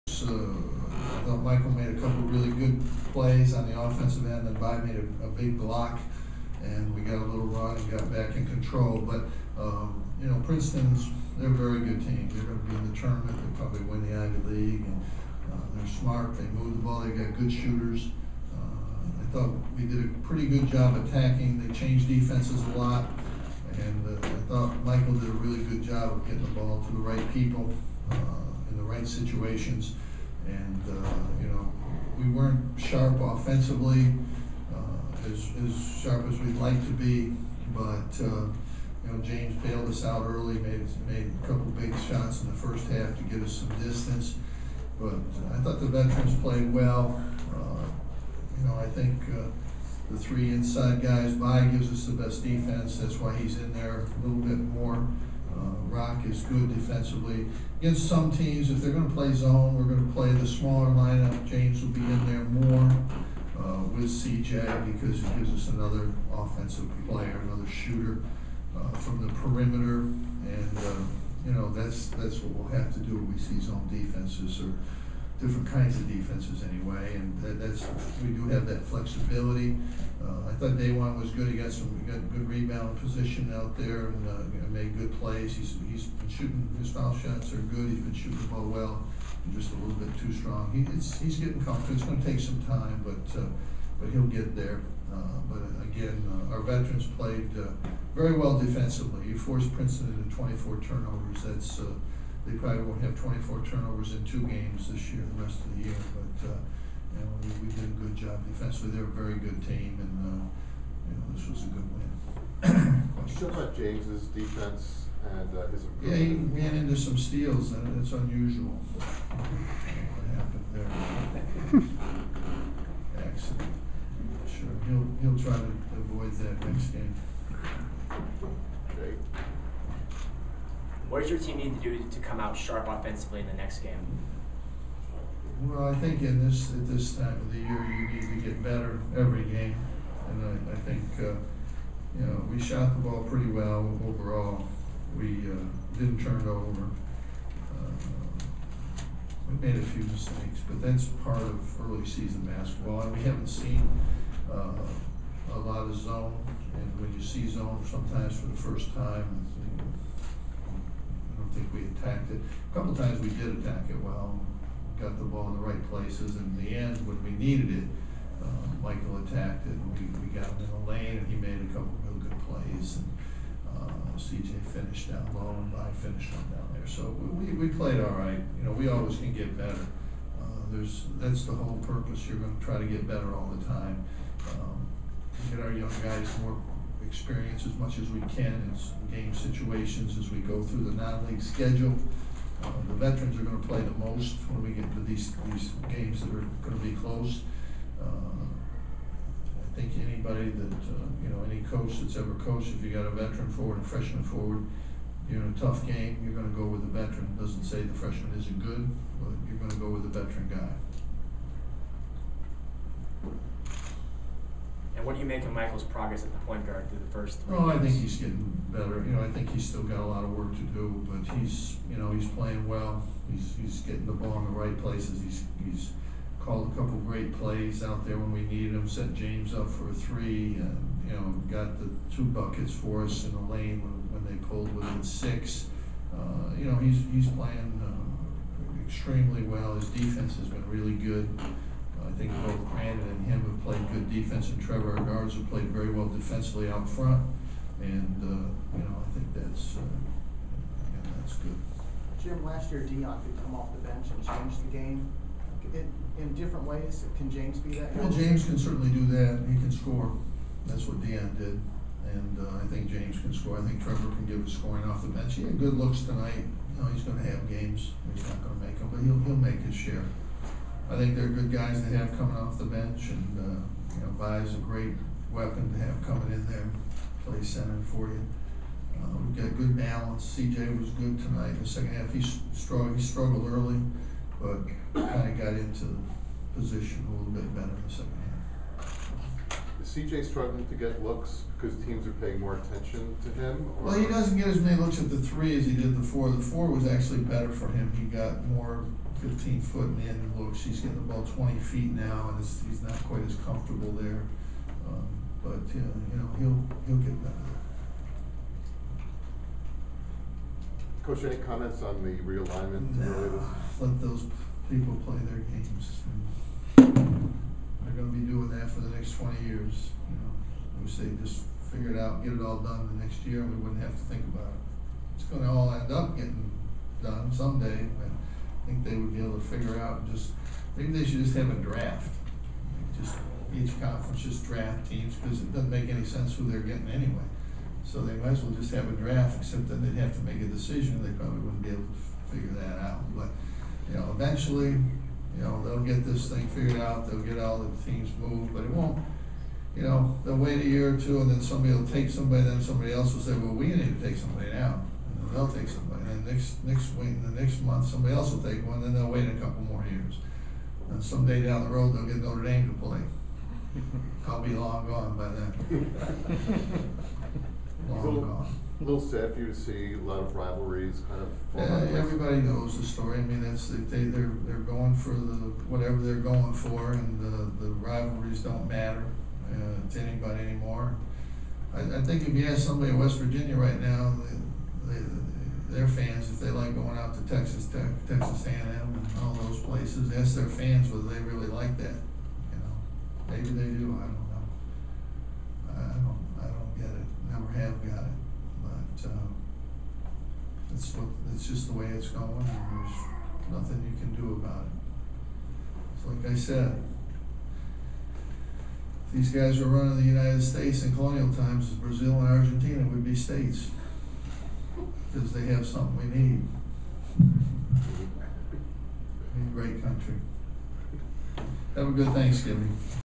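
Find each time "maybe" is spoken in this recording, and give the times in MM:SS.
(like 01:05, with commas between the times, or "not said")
05:30, 06:33.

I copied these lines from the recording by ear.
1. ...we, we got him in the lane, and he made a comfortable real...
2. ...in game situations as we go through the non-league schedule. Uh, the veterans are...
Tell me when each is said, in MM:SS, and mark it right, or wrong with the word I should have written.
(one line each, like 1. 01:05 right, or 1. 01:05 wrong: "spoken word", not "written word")
1. 02:49 wrong: "couple", not "comfortable"
2. 03:08 right.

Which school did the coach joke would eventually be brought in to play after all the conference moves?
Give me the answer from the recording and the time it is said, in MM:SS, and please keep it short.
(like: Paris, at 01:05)
Notre Dame, at 06:02.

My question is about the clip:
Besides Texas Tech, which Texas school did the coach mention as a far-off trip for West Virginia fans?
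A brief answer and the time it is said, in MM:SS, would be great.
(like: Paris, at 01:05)
Texas A&M, at 06:28.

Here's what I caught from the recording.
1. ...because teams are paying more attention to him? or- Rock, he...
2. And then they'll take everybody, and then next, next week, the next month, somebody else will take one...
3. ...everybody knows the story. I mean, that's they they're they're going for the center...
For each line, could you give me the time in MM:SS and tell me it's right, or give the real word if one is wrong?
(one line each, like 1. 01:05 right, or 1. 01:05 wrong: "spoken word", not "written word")
1. 04:51 wrong: "Well", not "Rock"
2. 05:55 wrong: "somebody", not "everybody"
3. 06:11 wrong: "whatever", not "center".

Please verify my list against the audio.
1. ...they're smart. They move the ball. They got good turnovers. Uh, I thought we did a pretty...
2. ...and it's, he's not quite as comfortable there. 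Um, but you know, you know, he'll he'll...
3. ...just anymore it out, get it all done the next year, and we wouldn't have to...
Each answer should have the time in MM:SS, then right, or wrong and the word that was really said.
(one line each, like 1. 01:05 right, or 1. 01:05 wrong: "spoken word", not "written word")
1. 00:15 wrong: "shooters", not "turnovers"
2. 05:02 right
3. 05:21 wrong: "figure", not "anymore".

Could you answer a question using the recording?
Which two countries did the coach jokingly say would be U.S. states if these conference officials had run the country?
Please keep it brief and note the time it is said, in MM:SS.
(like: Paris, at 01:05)
Brazil and Argentina, at 06:51.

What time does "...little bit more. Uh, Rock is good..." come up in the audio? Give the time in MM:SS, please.
00:54.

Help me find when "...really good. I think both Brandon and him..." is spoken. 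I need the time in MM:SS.
04:00.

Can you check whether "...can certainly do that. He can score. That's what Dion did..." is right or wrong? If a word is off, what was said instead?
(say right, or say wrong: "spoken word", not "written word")
right.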